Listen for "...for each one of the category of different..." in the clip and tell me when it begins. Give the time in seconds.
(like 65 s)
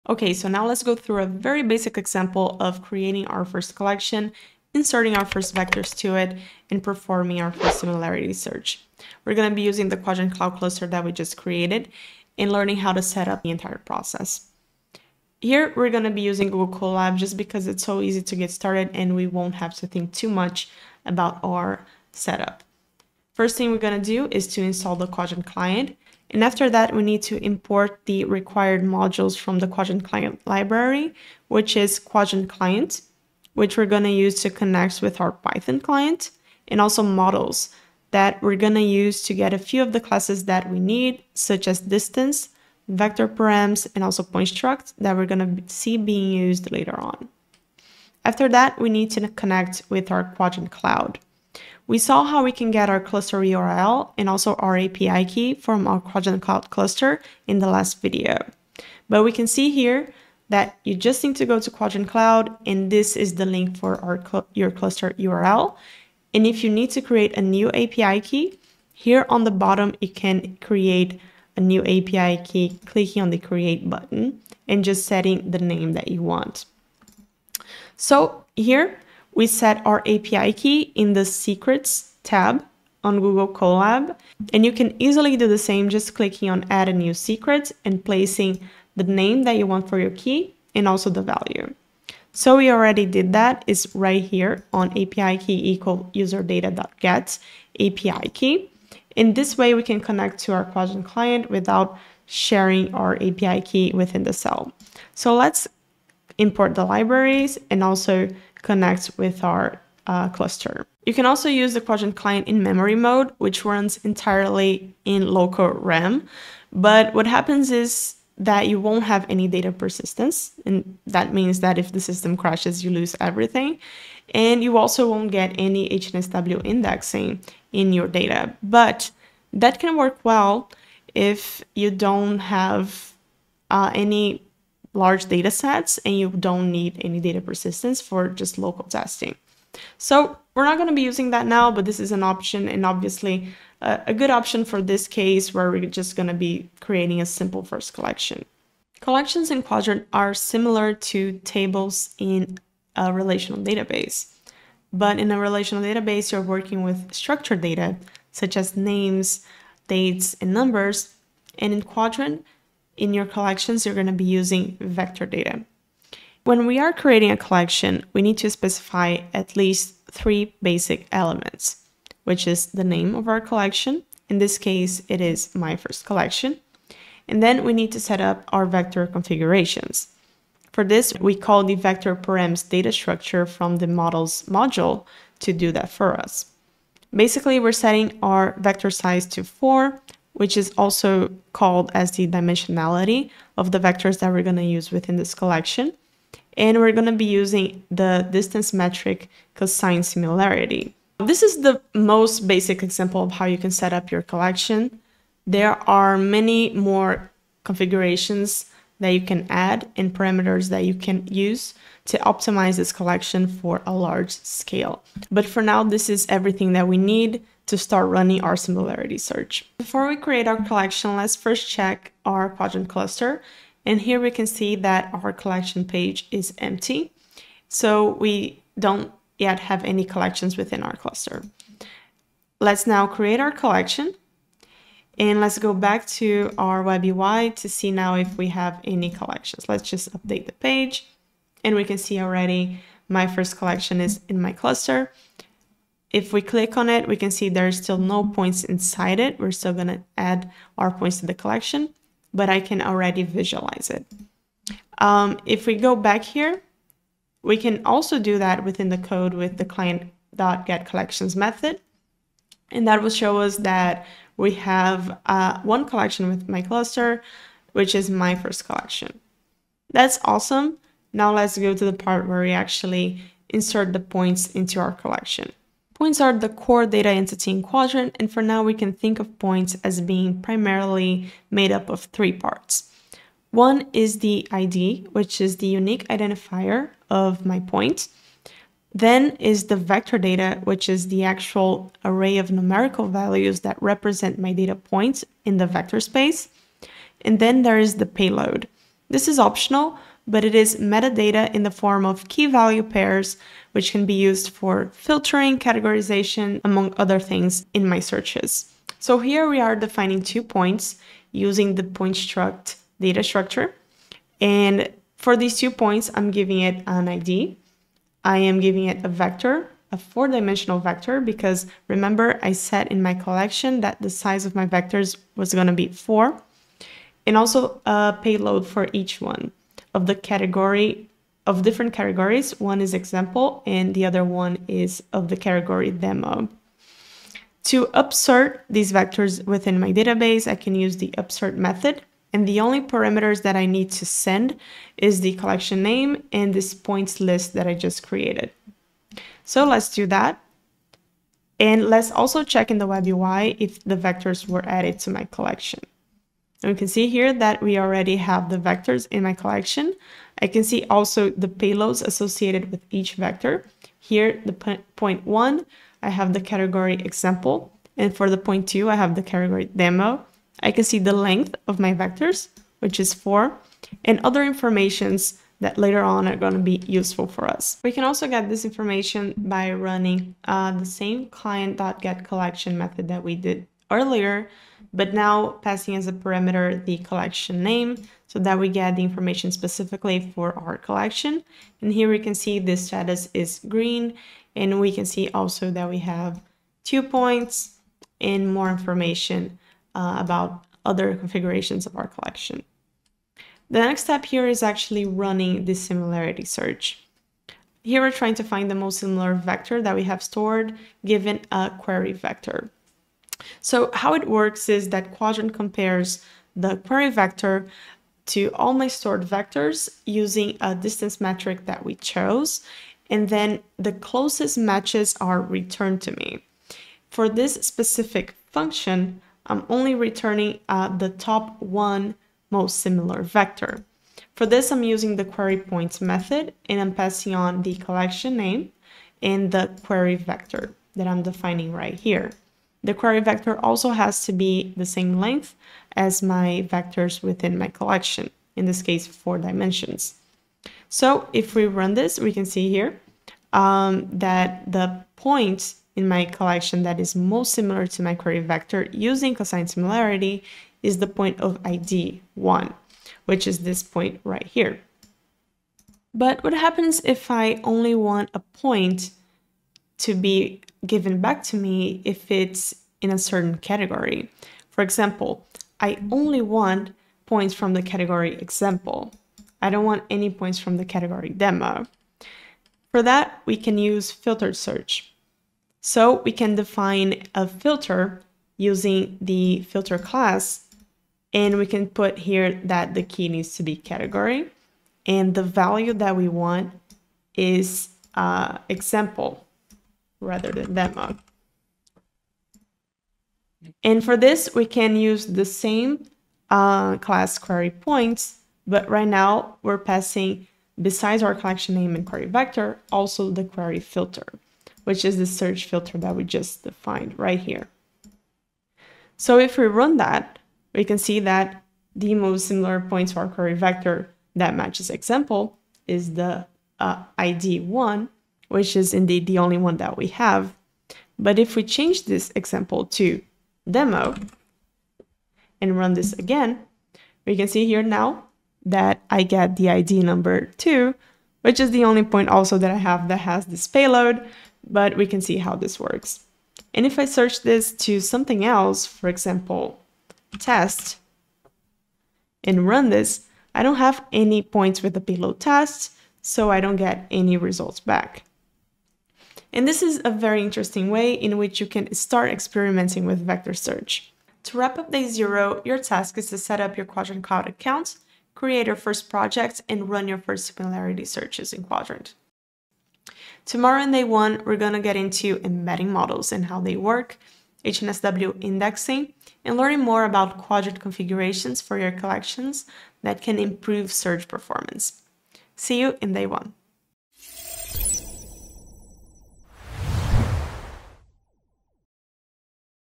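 328 s.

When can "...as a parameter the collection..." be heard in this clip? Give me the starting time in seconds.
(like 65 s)
385 s.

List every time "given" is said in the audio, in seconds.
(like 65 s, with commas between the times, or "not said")
411 s, 470 s.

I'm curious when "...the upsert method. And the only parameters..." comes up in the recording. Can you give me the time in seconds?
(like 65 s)
340 s.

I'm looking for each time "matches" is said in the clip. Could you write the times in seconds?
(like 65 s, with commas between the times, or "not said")
424 s, 524 s.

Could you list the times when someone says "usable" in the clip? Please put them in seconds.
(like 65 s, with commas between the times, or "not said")
not said.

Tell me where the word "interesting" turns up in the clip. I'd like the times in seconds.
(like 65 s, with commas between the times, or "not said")
560 s.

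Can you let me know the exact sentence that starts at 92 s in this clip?
So we already did that; it's right here on API key equal user data.get API key.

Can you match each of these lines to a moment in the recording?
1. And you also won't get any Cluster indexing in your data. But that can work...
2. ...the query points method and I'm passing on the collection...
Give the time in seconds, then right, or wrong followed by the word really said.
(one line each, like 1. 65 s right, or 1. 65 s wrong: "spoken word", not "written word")
1. 124 s wrong: "HNSW", not "Cluster"
2. 435 s right.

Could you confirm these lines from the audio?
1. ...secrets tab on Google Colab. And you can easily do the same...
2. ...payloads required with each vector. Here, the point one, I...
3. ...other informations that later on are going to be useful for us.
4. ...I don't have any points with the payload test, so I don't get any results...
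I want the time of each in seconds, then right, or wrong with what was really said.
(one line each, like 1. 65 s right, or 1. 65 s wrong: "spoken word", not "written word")
1. 81 s right
2. 361 s wrong: "associated", not "required"
3. 374 s right
4. 553 s right.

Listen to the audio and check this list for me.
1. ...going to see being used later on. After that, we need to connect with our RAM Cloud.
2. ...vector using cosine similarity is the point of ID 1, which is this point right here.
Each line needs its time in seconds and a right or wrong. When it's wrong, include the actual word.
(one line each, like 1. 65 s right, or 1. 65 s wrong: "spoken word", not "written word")
1. 45 s wrong: "Qdrant", not "RAM"
2. 458 s right.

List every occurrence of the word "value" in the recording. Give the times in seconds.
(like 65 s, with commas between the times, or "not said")
91 s, 293 s, 302 s, 495 s.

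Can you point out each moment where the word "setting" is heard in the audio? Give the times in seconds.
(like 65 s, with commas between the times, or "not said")
75 s, 187 s.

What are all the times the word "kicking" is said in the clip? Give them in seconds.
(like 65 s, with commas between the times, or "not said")
not said.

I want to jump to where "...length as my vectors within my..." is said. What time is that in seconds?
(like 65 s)
445 s.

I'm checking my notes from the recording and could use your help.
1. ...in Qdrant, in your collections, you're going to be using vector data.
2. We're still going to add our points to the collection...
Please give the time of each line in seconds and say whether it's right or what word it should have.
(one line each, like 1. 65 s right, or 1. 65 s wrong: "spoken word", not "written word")
1. 161 s right
2. 249 s right.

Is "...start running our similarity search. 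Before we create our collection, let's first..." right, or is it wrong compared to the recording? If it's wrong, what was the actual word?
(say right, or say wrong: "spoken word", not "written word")
right.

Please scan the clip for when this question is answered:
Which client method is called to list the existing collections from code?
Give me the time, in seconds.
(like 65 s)
259 s.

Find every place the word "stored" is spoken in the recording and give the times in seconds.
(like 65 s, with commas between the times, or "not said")
410 s, 418 s.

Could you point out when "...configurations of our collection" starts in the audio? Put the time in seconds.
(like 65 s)
401 s.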